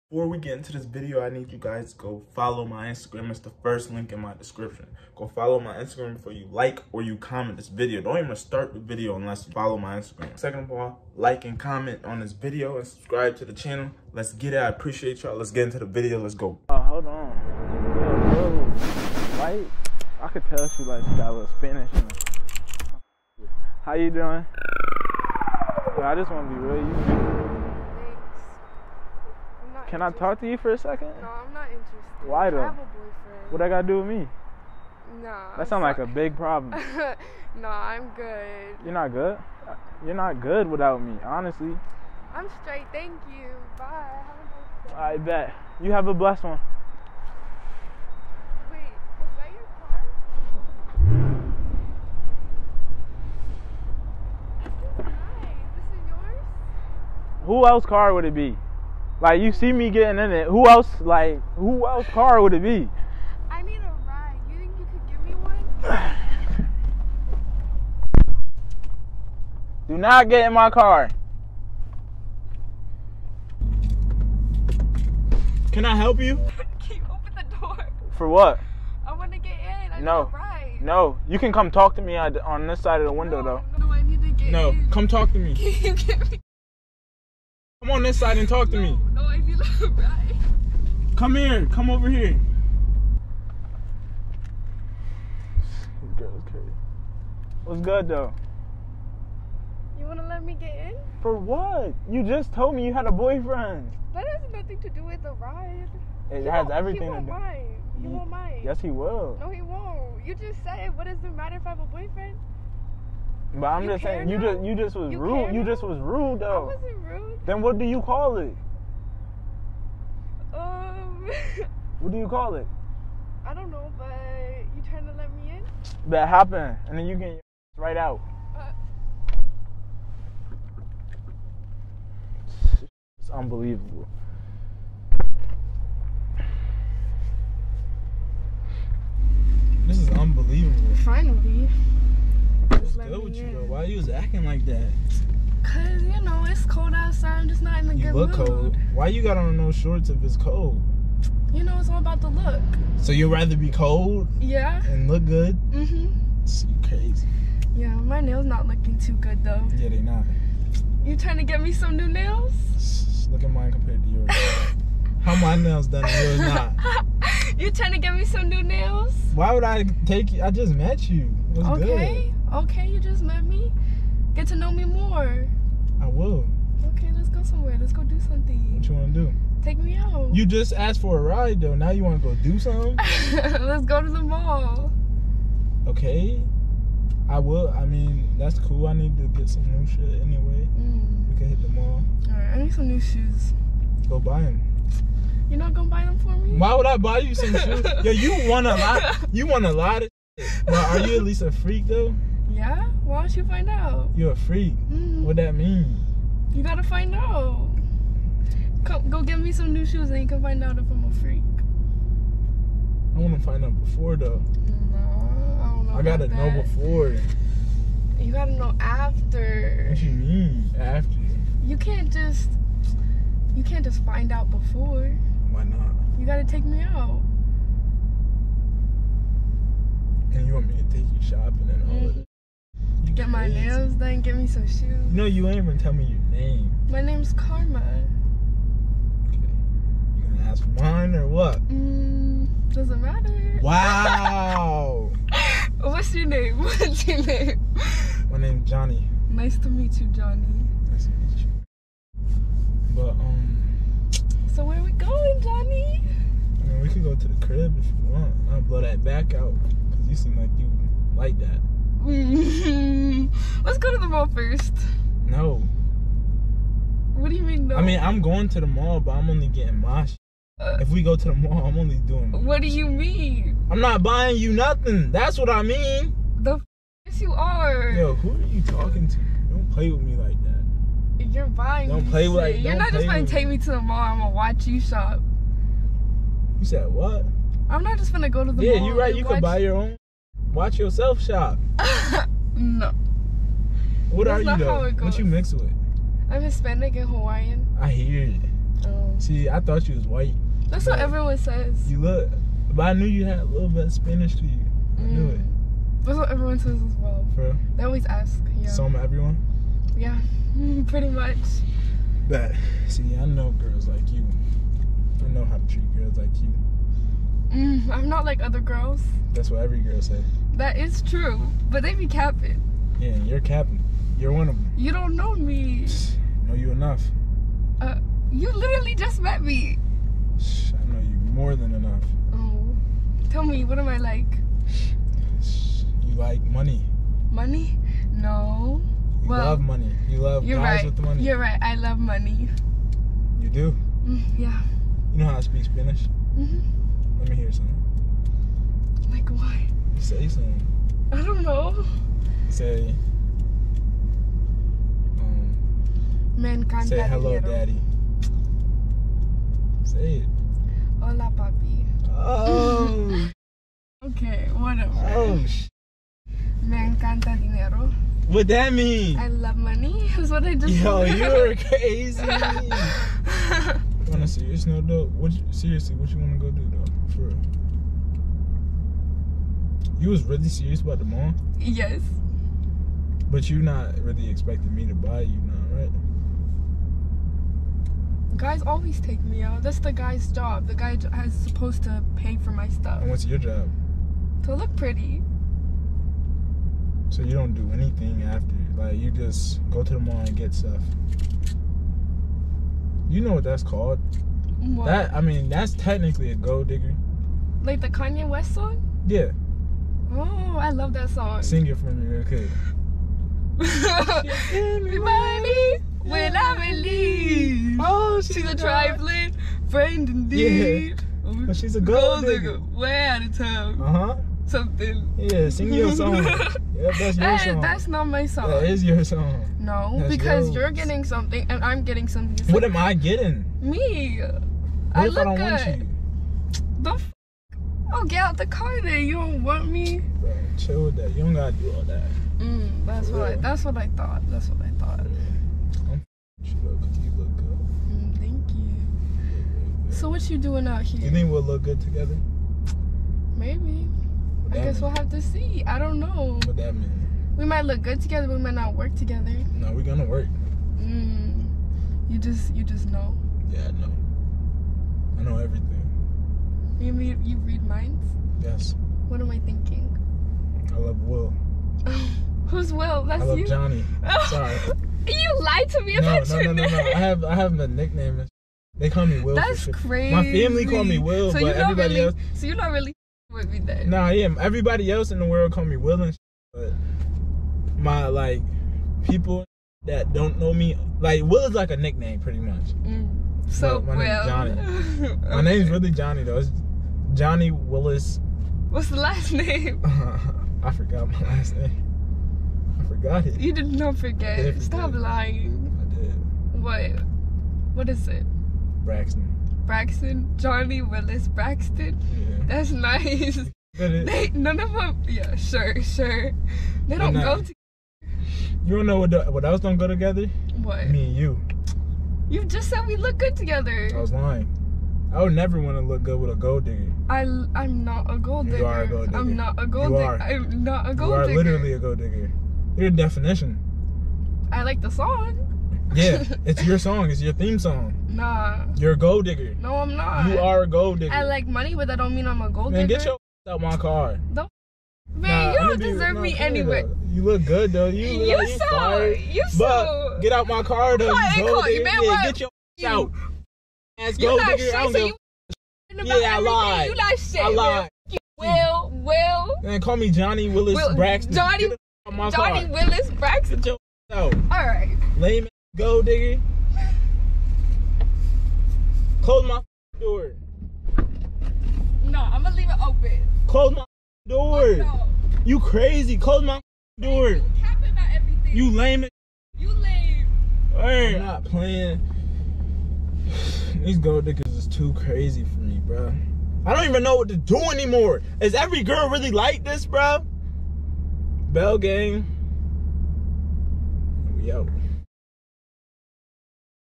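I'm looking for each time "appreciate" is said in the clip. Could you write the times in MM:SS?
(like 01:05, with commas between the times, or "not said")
00:14.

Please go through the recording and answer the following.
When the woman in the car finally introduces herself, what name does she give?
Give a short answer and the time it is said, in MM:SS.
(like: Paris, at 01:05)
Karma, at 03:57.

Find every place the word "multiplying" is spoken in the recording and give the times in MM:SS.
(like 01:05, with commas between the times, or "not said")
not said.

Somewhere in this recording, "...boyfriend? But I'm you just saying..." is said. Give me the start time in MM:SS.
01:51.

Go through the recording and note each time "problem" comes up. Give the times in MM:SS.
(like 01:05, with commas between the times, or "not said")
00:36.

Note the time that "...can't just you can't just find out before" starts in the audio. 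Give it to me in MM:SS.
03:41.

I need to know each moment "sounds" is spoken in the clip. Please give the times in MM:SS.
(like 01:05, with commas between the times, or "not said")
00:35.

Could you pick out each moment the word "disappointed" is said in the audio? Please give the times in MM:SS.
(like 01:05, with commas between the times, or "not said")
not said.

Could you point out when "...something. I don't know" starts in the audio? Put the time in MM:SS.
05:50.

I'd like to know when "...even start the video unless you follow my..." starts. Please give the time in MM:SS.
00:08.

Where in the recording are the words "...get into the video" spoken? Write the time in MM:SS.
00:15.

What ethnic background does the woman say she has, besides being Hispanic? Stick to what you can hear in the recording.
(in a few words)
Hawaiian.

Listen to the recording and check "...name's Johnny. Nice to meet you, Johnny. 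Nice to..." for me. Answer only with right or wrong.
right.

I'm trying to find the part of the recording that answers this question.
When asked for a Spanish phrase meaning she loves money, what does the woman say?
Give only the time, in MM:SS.
06:06.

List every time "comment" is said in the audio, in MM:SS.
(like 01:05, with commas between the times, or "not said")
00:07, 00:11.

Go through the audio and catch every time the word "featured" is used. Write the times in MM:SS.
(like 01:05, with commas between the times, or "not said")
not said.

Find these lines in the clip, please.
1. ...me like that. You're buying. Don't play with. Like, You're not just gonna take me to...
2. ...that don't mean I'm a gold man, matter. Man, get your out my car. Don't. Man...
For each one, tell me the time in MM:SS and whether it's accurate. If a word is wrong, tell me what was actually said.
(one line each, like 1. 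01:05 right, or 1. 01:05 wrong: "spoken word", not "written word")
1. 04:40 right
2. 09:01 wrong: "digger", not "matter".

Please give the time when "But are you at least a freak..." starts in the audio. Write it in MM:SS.
03:20.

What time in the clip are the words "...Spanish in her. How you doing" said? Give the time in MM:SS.
00:21.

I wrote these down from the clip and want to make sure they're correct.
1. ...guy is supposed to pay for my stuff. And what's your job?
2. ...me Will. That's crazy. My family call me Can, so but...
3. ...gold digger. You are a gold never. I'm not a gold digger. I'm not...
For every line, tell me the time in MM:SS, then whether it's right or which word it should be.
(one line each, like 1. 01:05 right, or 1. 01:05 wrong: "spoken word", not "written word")
1. 06:30 right
2. 07:59 wrong: "Will", not "Can"
3. 08:48 wrong: "digger", not "never".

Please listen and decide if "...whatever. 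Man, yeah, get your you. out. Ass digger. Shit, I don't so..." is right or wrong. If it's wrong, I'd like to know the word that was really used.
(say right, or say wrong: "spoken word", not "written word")
wrong: "digger", not "whatever".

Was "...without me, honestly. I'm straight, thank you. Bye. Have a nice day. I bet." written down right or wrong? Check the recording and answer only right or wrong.
right.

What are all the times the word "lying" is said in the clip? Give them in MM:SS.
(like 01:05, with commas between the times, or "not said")
08:25, 08:44.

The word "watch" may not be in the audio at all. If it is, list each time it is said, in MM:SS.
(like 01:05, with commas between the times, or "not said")
04:44, 04:50.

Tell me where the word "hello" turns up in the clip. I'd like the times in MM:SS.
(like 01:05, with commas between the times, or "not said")
05:57.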